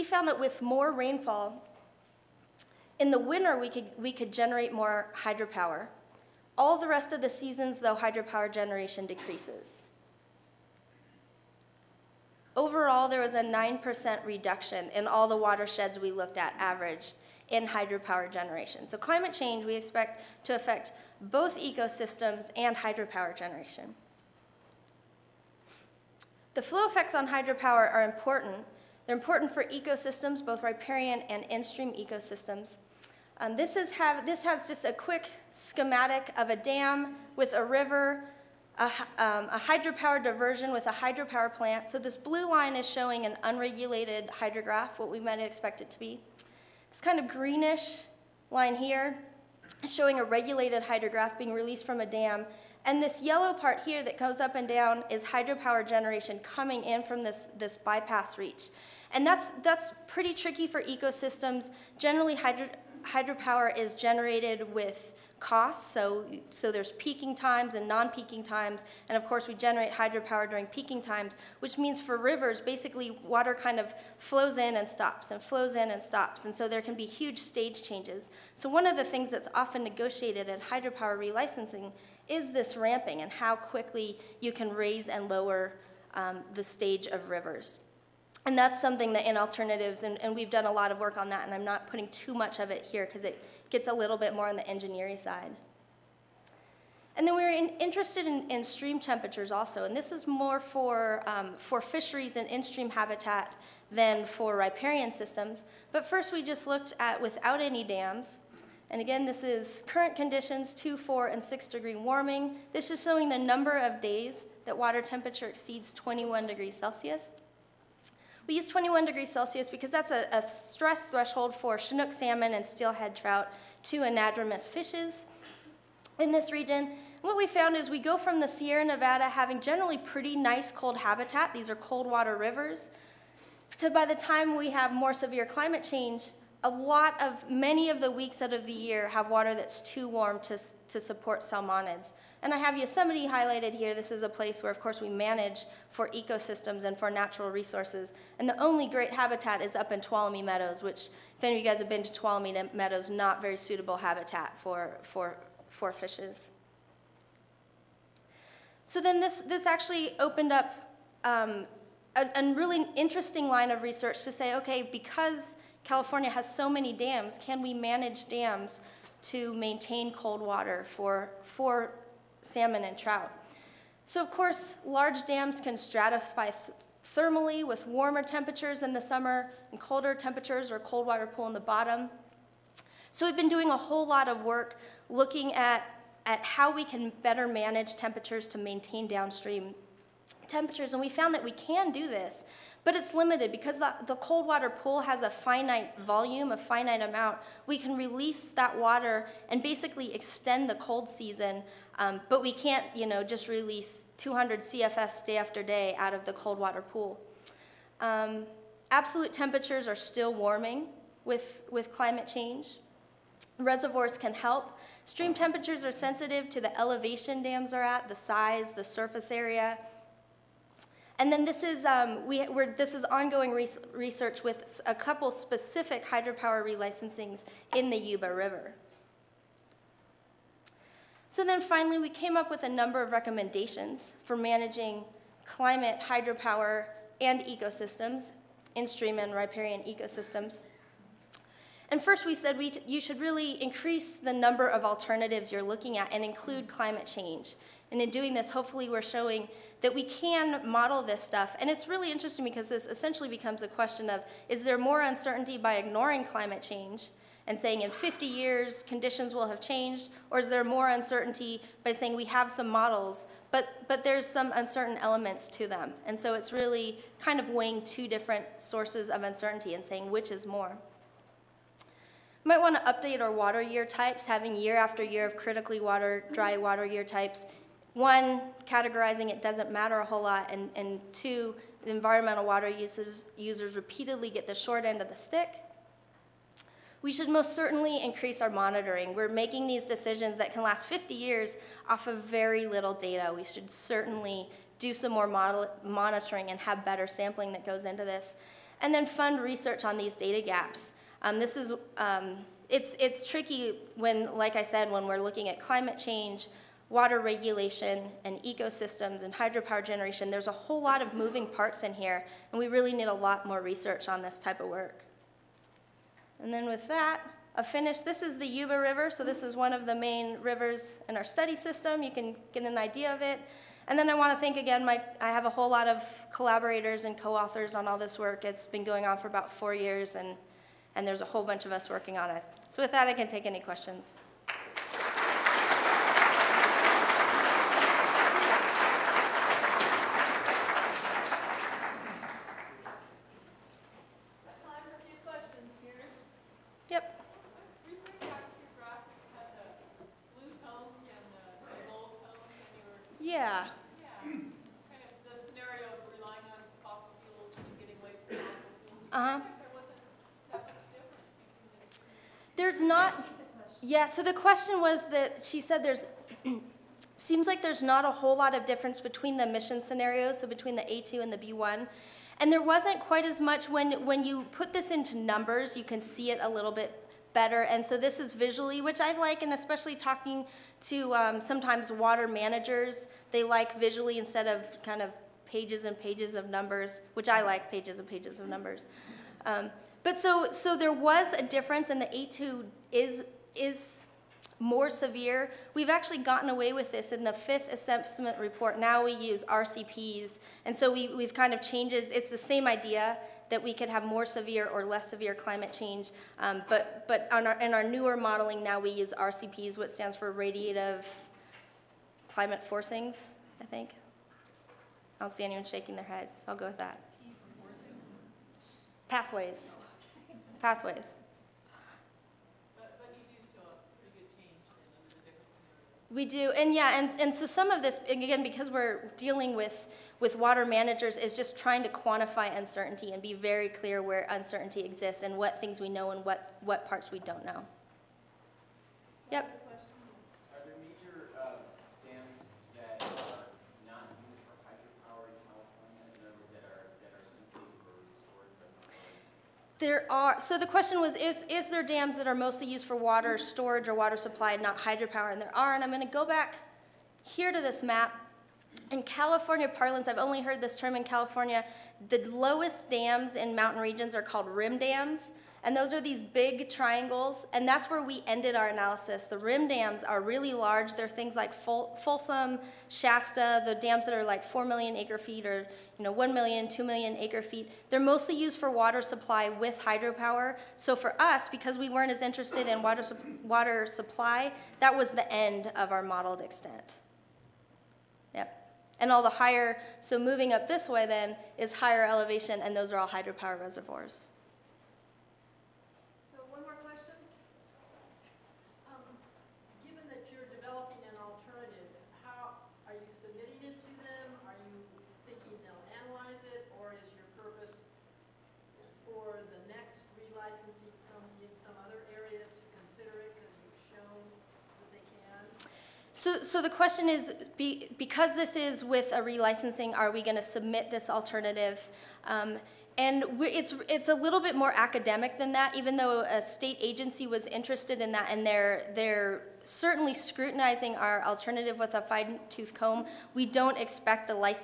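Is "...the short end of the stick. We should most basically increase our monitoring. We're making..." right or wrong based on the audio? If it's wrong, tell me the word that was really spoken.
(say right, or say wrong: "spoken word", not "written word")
wrong: "certainly", not "basically".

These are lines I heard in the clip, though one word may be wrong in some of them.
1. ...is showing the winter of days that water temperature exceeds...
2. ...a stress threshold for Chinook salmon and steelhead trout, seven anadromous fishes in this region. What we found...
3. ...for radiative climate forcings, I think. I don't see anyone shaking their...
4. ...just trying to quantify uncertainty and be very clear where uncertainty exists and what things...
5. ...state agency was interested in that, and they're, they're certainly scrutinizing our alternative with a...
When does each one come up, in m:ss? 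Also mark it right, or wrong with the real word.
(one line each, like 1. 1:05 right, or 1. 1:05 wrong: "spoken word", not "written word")
1. 1:52 wrong: "number", not "winter"
2. 2:00 wrong: "two", not "seven"
3. 6:50 right
4. 7:11 right
5. 8:46 right.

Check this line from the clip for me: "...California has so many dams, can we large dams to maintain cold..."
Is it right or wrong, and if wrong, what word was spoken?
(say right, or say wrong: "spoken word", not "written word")
wrong: "manage", not "large".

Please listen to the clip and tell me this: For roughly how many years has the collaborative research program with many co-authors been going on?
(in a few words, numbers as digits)
4 years.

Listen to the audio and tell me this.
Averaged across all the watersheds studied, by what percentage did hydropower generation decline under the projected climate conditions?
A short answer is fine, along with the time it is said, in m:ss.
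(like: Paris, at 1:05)
9%, at 0:13.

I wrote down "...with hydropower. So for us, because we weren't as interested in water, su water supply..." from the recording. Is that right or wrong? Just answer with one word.
right.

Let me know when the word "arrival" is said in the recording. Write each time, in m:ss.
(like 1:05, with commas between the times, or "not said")
not said.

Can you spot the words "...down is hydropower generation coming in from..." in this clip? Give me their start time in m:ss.
0:54.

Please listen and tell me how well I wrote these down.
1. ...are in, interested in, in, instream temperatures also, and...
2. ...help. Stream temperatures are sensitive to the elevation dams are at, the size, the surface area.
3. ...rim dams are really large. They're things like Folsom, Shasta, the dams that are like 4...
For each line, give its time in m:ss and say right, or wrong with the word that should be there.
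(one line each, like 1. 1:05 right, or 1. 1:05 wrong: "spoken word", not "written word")
1. 1:37 wrong: "stream", not "instream"
2. 3:34 right
3. 7:49 right.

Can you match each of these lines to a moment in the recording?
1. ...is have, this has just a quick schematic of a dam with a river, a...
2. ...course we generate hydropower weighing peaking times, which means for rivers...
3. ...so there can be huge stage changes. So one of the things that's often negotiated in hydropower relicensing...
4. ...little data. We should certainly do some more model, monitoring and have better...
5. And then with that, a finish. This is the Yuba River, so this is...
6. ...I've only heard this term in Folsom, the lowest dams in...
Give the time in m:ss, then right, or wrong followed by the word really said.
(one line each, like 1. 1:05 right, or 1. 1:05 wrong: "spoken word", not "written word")
1. 0:33 right
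2. 1:09 wrong: "during", not "weighing"
3. 1:16 right
4. 4:52 right
5. 5:16 right
6. 7:40 wrong: "California", not "Folsom".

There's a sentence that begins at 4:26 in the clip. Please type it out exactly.
And so it's really kind of weighing two different sources of uncertainty and saying which is more.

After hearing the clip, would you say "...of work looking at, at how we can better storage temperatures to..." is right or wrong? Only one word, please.
wrong.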